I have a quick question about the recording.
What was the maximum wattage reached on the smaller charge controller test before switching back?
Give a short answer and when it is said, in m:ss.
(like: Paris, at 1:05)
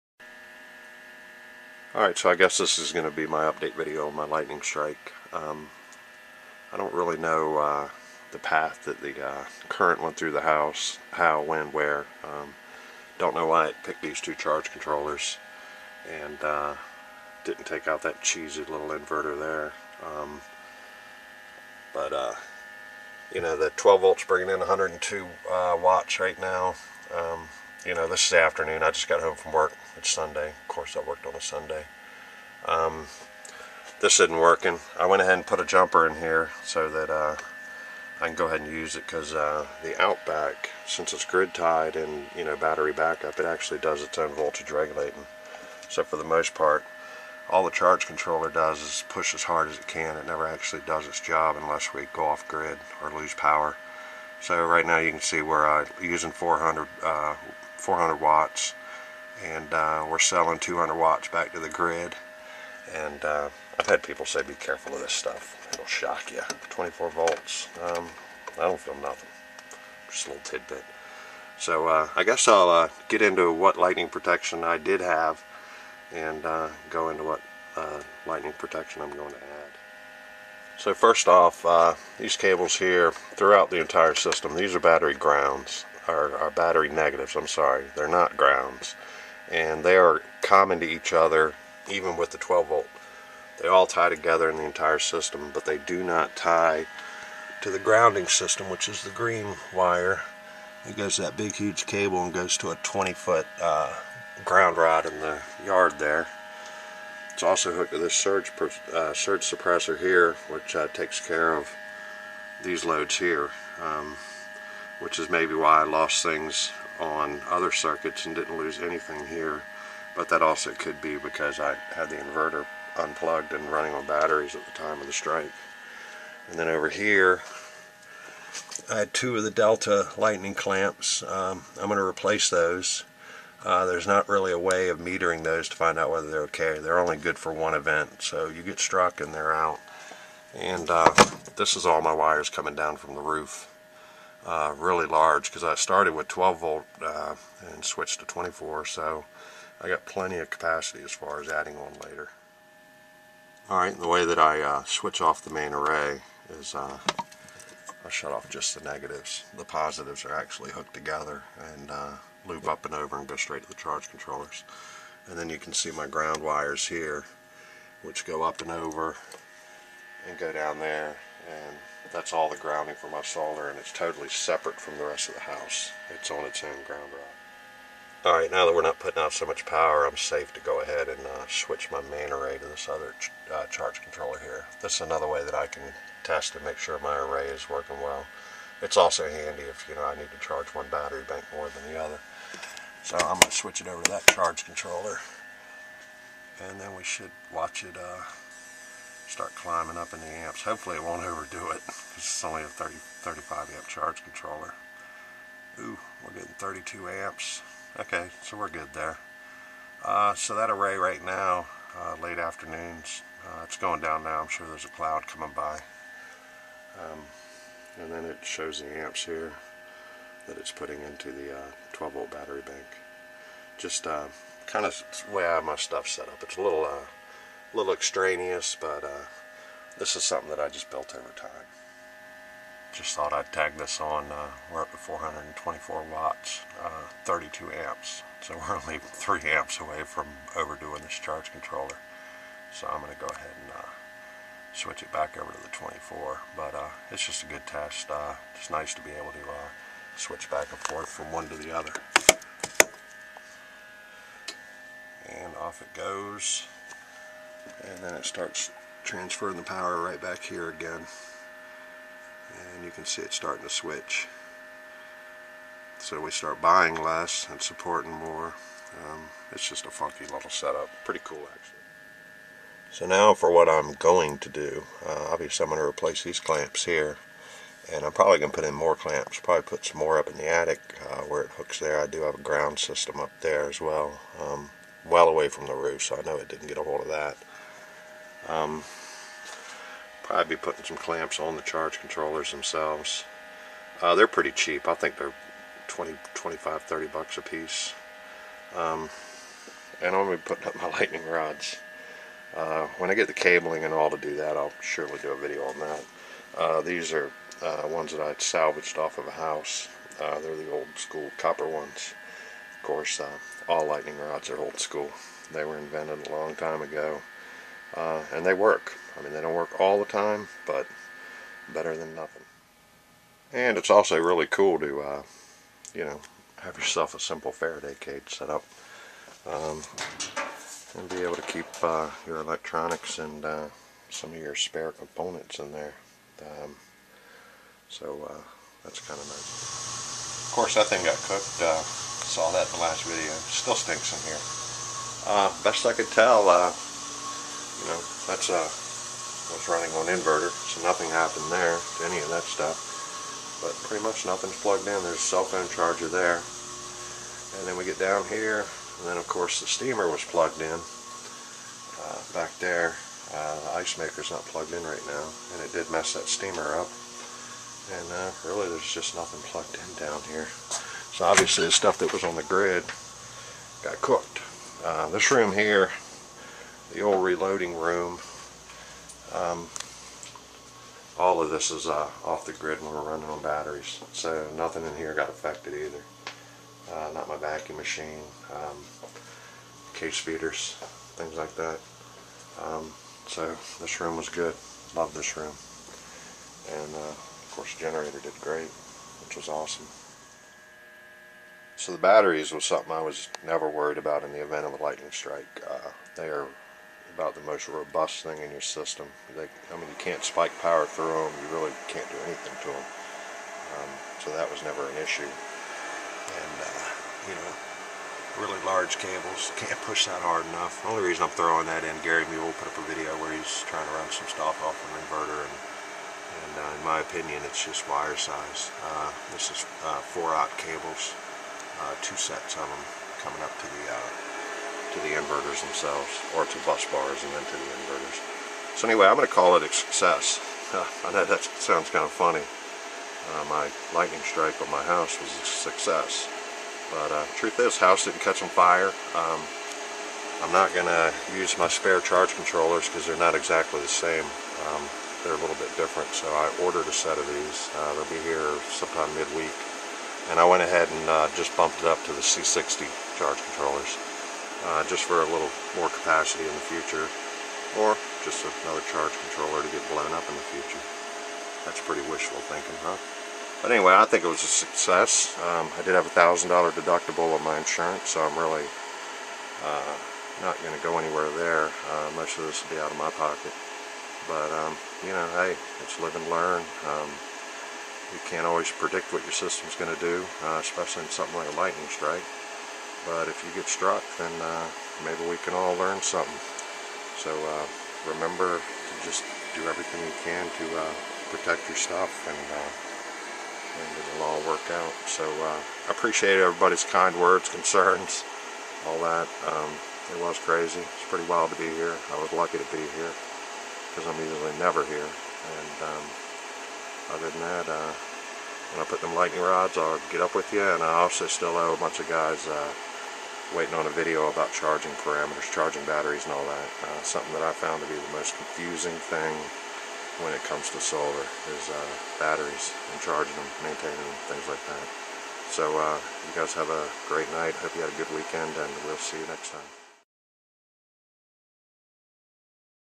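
424 watts, at 3:54.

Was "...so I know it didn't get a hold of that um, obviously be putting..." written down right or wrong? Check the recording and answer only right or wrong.
wrong.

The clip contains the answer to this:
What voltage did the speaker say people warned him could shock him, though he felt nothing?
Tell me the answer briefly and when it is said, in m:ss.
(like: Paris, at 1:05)
24 volts, at 1:06.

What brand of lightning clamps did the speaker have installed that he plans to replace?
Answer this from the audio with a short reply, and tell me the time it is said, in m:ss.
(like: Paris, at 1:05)
Delta, at 2:09.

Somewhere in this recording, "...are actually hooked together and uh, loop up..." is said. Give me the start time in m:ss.
2:40.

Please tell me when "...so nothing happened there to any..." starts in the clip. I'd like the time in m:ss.
5:50.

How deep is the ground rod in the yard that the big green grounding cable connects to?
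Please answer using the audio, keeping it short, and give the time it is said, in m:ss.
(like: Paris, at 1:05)
20 foot, at 1:42.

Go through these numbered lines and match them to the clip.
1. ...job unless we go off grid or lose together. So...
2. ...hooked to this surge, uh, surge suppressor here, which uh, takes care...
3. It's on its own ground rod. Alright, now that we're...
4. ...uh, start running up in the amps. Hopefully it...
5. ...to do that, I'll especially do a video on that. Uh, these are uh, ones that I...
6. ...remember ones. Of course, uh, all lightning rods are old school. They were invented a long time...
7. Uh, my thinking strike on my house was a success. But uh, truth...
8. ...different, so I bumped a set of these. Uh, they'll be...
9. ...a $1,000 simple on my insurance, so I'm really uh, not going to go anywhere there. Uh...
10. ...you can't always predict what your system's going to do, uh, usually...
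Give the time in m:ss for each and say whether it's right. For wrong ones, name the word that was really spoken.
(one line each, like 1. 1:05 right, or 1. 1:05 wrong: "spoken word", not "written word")
1. 0:51 wrong: "power", not "together"
2. 1:47 right
3. 2:56 right
4. 3:17 wrong: "climbing", not "running"
5. 5:04 wrong: "surely", not "especially"
6. 5:11 wrong: "copper", not "remember"
7. 7:22 wrong: "lightning", not "thinking"
8. 7:35 wrong: "ordered", not "bumped"
9. 7:56 wrong: "deductible", not "simple"
10. 8:08 wrong: "especially", not "usually".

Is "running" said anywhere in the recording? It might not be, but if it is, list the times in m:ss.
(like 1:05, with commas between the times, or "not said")
2:03, 5:49, 6:23.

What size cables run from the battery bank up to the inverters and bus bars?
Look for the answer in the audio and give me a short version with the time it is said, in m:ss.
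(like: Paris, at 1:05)
four-aught, at 7:10.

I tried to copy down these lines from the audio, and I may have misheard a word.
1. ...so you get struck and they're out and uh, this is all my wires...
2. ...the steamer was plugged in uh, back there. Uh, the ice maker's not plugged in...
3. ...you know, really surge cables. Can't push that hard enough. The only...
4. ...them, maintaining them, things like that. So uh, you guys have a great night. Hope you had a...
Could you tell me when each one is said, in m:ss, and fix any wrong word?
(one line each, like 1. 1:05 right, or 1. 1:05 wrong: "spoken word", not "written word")
1. 2:18 right
2. 5:59 right
3. 6:57 wrong: "large", not "surge"
4. 8:53 right.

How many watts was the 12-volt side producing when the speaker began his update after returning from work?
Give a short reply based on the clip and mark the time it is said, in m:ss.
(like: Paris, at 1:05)
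102 watts, at 0:24.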